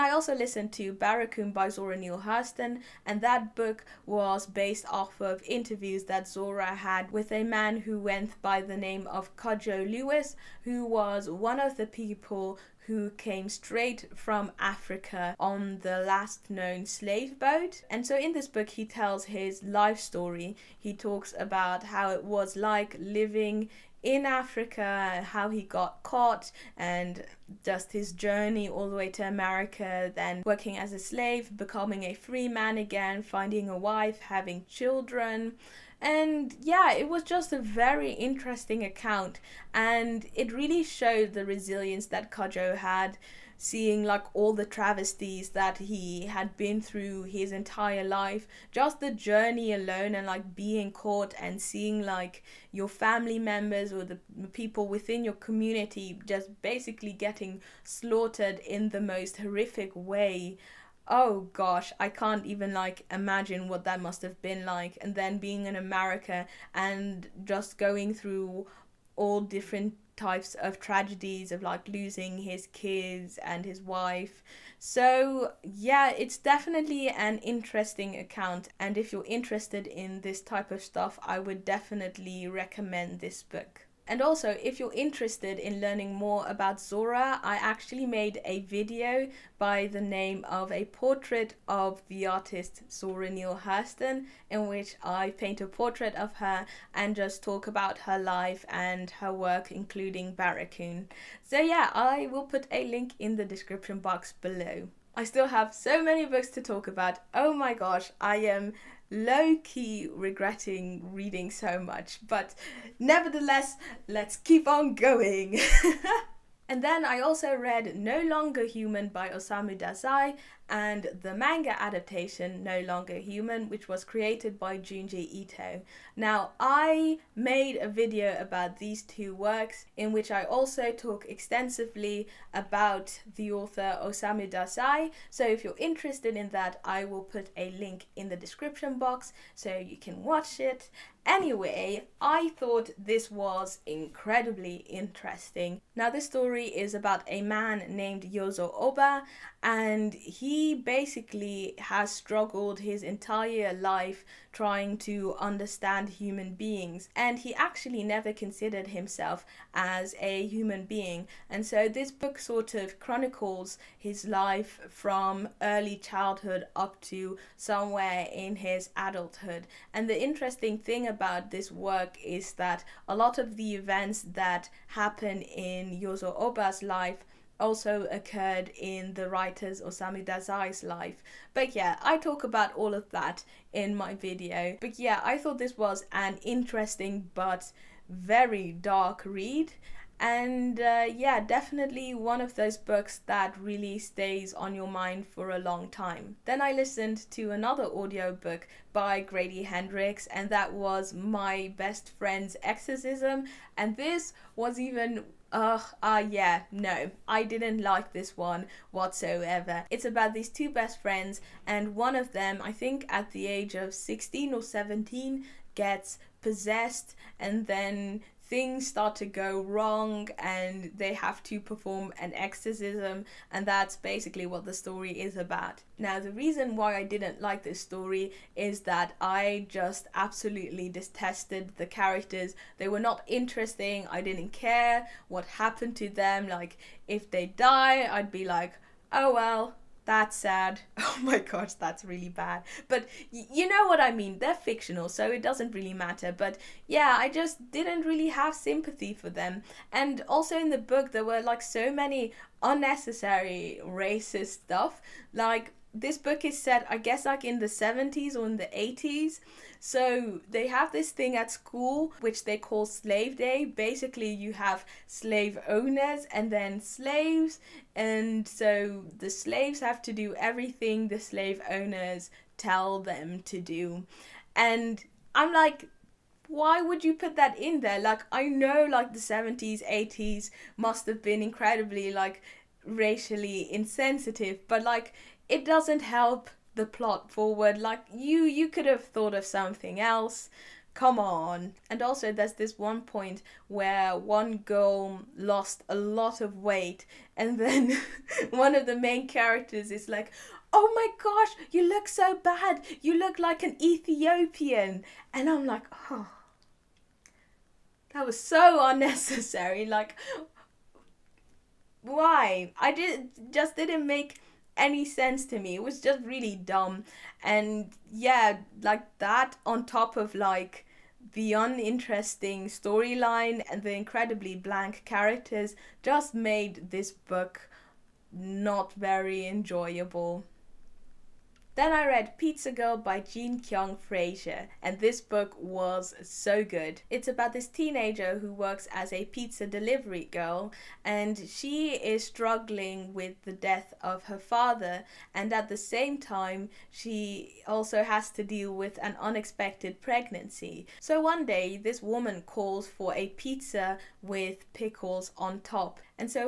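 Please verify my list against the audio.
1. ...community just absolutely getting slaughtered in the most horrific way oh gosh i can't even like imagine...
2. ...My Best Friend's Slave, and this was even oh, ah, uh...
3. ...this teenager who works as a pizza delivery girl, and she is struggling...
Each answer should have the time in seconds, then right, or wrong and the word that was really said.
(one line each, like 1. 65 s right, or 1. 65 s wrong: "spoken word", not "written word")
1. 55 s wrong: "basically", not "absolutely"
2. 201 s wrong: "Exorcism", not "Slave"
3. 337 s right.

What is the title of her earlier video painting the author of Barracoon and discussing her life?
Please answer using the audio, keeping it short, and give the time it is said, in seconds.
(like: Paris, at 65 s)
A Portrait of the Artist Zora Neale Hurston, at 90 s.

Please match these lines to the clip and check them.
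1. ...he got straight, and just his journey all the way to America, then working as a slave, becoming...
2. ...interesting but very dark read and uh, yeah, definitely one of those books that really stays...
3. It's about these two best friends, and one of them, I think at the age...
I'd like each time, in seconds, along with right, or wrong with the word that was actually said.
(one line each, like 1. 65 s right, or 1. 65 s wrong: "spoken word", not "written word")
1. 25 s wrong: "caught", not "straight"
2. 186 s right
3. 209 s right.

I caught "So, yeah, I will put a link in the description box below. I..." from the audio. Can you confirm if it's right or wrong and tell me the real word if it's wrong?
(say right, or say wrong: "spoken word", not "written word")
right.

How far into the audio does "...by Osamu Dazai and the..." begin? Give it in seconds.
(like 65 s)
119 s.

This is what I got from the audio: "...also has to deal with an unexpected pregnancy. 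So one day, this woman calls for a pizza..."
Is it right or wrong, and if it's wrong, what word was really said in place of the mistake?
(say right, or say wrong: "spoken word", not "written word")
right.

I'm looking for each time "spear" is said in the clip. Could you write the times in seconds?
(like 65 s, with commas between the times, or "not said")
not said.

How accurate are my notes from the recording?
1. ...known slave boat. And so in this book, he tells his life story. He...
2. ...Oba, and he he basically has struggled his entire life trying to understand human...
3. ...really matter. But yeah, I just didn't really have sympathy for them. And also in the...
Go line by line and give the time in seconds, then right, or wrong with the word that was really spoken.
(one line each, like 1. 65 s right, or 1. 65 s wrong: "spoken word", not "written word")
1. 16 s right
2. 148 s right
3. 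245 s right.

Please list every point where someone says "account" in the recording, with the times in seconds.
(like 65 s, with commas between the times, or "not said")
38 s, 78 s.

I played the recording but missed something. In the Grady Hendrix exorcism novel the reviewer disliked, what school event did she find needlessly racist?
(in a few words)
Slave Day.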